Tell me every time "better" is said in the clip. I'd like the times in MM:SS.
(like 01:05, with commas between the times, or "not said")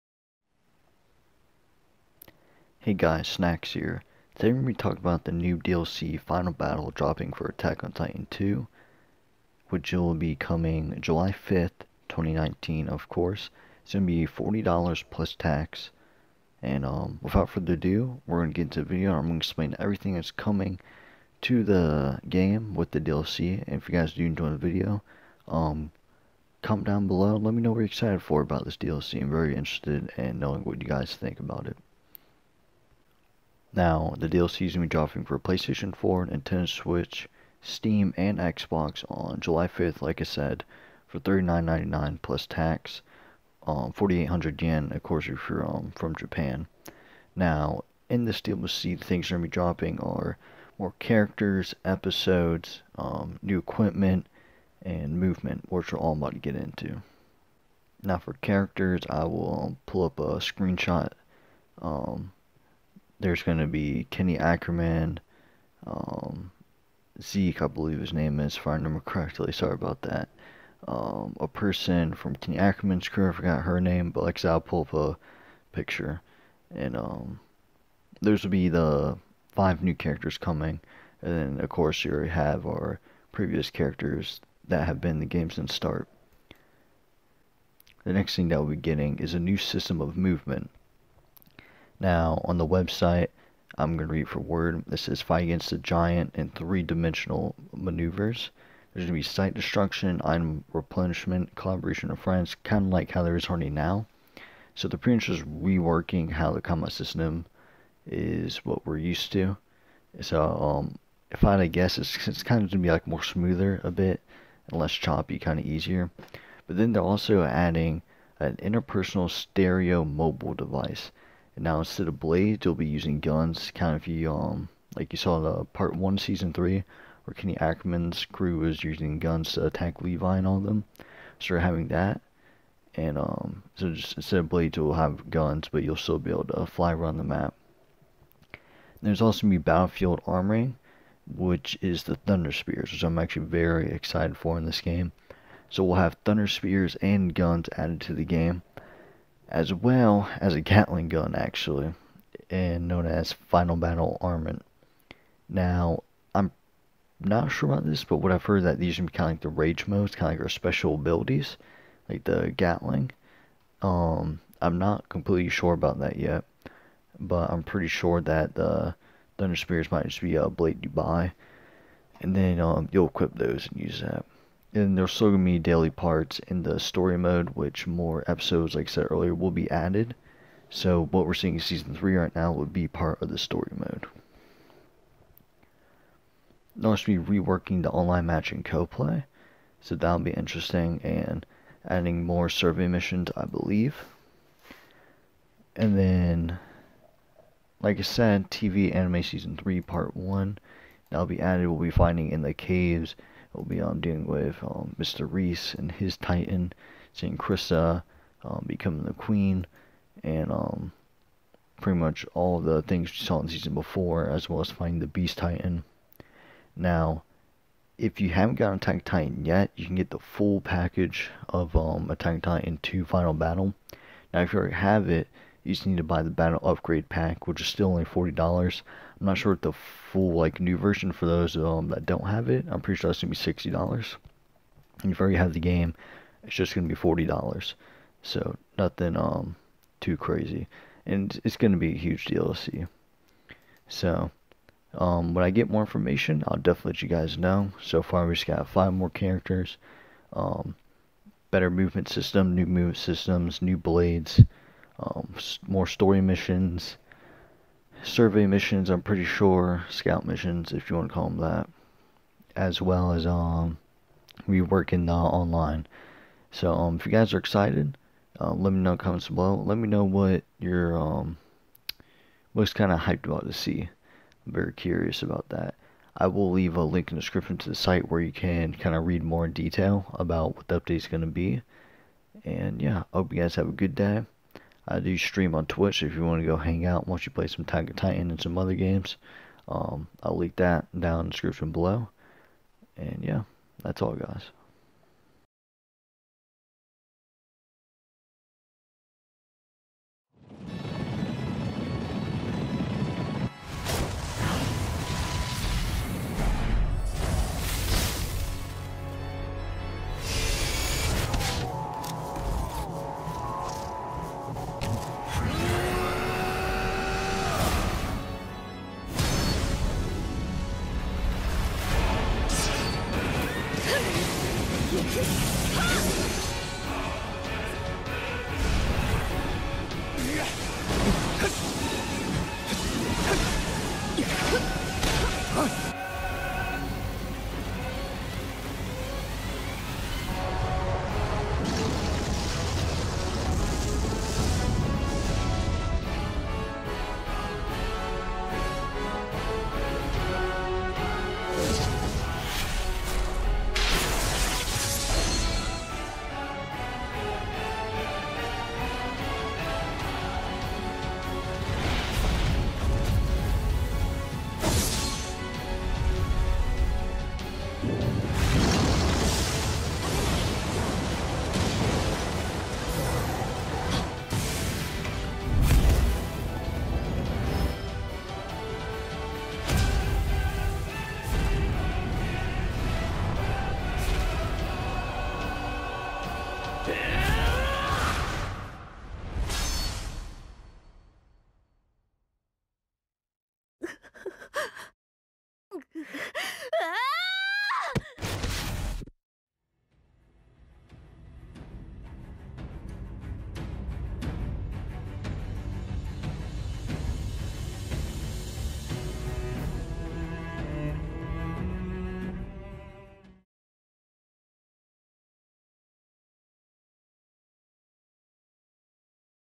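04:11.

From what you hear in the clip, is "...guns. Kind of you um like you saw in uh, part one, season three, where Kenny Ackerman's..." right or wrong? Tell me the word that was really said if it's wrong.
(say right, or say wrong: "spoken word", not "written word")
right.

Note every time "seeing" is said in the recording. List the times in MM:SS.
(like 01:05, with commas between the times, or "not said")
03:01, 03:27.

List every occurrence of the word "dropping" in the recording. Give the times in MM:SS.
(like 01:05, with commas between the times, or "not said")
00:06, 00:34, 00:49.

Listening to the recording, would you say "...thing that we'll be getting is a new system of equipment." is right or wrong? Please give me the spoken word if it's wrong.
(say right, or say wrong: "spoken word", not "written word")
wrong: "movement", not "equipment".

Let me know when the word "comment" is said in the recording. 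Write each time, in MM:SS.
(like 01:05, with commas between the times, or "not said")
00:26, 04:28.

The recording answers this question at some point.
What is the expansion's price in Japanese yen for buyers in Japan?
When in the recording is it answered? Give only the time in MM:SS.
00:43.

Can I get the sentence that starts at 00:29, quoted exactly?
I'm very interested in knowing what you guys think about it.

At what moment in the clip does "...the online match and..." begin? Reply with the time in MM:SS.
03:07.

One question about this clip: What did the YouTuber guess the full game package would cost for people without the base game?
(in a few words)
$60.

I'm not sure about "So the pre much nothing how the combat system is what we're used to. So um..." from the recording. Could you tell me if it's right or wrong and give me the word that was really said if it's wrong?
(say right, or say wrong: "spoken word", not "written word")
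wrong: "reworking", not "nothing".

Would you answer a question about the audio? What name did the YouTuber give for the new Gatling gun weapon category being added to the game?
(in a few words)
Final Battle Armament.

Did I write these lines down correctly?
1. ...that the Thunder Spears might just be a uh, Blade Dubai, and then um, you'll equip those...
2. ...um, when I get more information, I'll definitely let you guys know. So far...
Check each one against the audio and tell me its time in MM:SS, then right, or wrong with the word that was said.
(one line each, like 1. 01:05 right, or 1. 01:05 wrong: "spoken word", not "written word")
1. 02:48 right
2. 04:04 right.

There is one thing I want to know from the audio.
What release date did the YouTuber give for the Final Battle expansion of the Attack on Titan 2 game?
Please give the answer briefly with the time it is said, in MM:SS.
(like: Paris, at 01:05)
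July 5th, 2019, at 00:10.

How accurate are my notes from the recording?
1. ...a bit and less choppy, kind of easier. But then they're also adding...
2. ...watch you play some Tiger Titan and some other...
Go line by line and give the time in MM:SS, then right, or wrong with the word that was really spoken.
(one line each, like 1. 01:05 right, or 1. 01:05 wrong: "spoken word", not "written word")
1. 01:53 right
2. 04:47 right.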